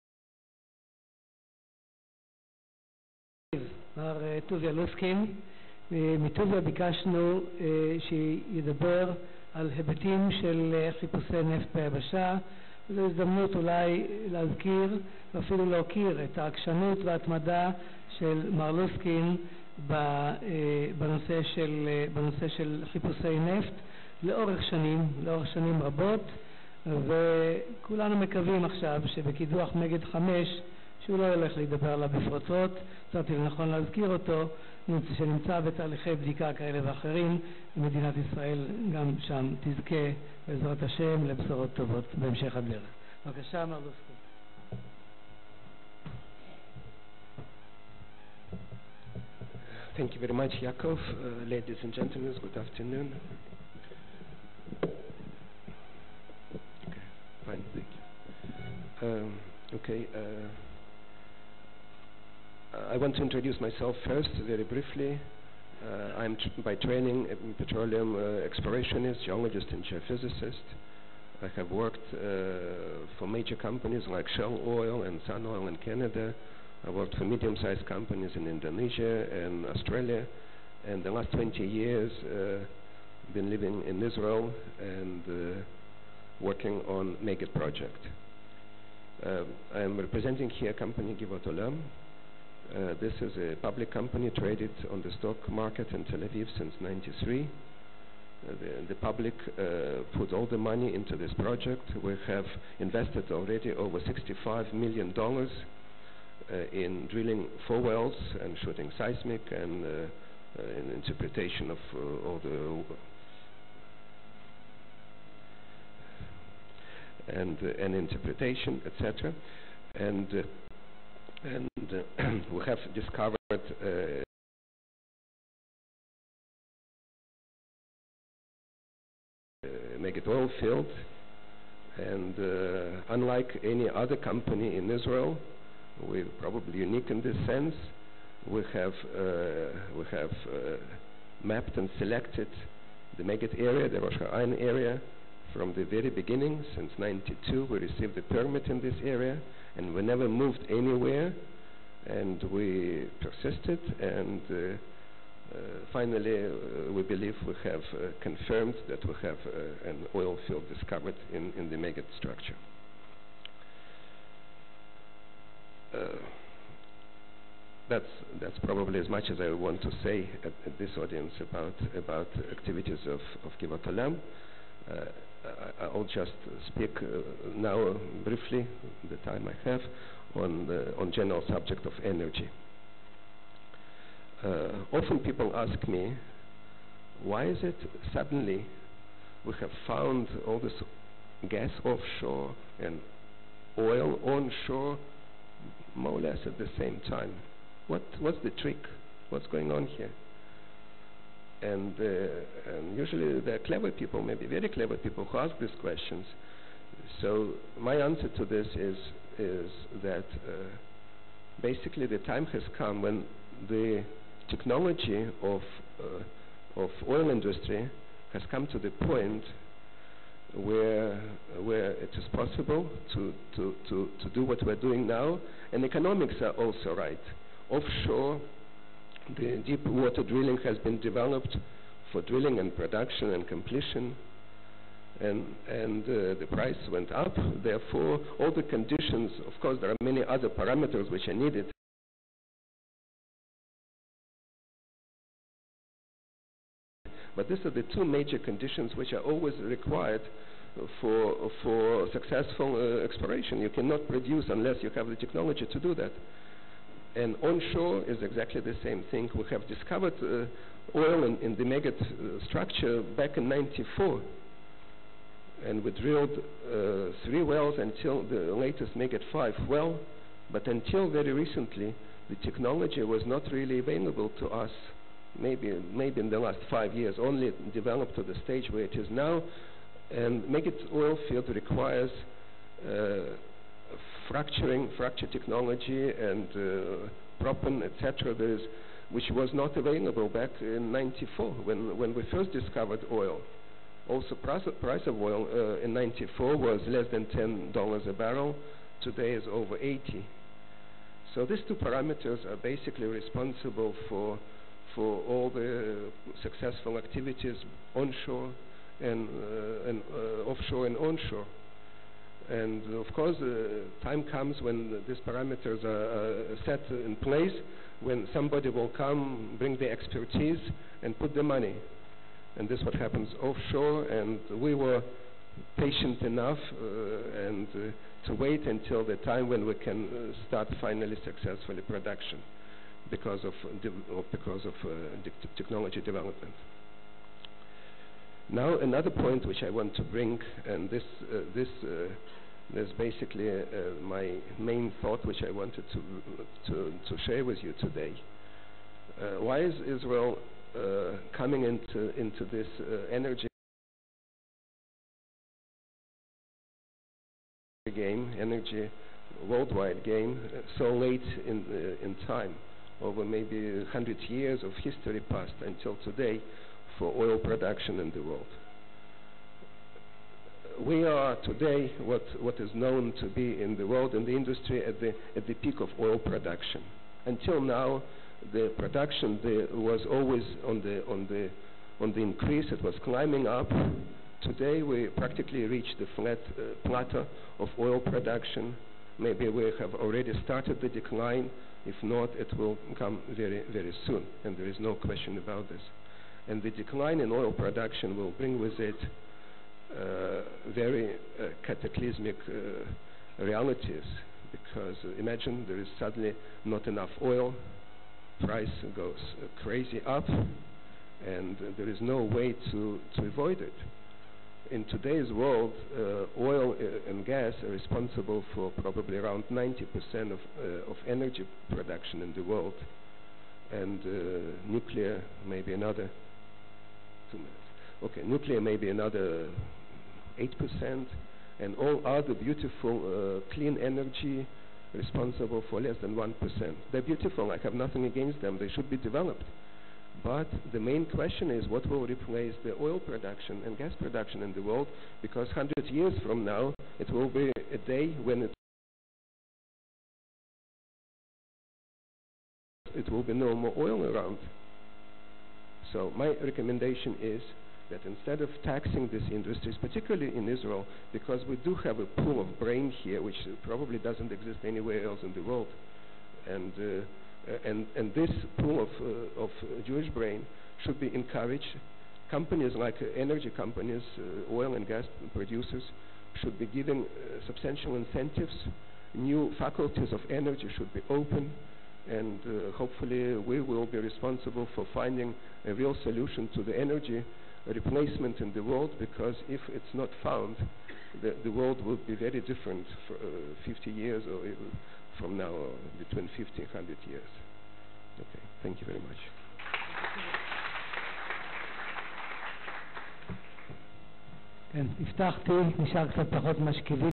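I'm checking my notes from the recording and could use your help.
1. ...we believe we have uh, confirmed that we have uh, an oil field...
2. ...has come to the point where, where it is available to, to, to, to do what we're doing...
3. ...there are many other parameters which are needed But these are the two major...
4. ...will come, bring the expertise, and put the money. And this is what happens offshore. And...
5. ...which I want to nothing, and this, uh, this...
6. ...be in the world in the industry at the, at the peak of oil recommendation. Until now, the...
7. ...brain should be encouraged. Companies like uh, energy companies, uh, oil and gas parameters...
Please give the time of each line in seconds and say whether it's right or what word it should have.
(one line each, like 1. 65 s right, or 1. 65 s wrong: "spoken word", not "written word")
1. 156 s right
2. 218 s wrong: "possible", not "available"
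3. 239 s right
4. 318 s right
5. 339 s wrong: "bring", not "nothing"
6. 373 s wrong: "production", not "recommendation"
7. 470 s wrong: "producers", not "parameters".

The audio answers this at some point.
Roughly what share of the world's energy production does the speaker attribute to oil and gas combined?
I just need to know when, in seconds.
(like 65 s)
419 s.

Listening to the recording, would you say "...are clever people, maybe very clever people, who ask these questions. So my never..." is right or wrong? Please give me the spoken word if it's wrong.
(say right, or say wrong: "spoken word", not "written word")
wrong: "answer", not "never".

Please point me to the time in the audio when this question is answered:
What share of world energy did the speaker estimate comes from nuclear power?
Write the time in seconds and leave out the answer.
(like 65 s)
430 s.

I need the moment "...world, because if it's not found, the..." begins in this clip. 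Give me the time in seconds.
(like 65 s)
488 s.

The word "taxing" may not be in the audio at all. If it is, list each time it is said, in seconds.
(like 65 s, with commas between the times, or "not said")
458 s.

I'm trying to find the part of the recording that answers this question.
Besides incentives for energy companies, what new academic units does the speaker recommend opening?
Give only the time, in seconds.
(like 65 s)
479 s.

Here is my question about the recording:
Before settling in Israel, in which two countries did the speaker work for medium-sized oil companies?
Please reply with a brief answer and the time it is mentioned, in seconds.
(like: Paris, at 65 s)
Indonesia and Australia, at 78 s.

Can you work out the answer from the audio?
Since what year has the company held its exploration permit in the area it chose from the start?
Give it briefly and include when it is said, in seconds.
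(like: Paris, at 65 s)
1992, at 146 s.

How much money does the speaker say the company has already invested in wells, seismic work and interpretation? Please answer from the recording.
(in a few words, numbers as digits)
Over $65 million.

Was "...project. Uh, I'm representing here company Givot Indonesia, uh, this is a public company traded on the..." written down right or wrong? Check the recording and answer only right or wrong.
wrong.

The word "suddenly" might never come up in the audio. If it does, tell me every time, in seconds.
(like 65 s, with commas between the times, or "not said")
188 s, 405 s.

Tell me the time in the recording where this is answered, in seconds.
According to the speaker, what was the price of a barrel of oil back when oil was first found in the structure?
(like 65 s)
296 s.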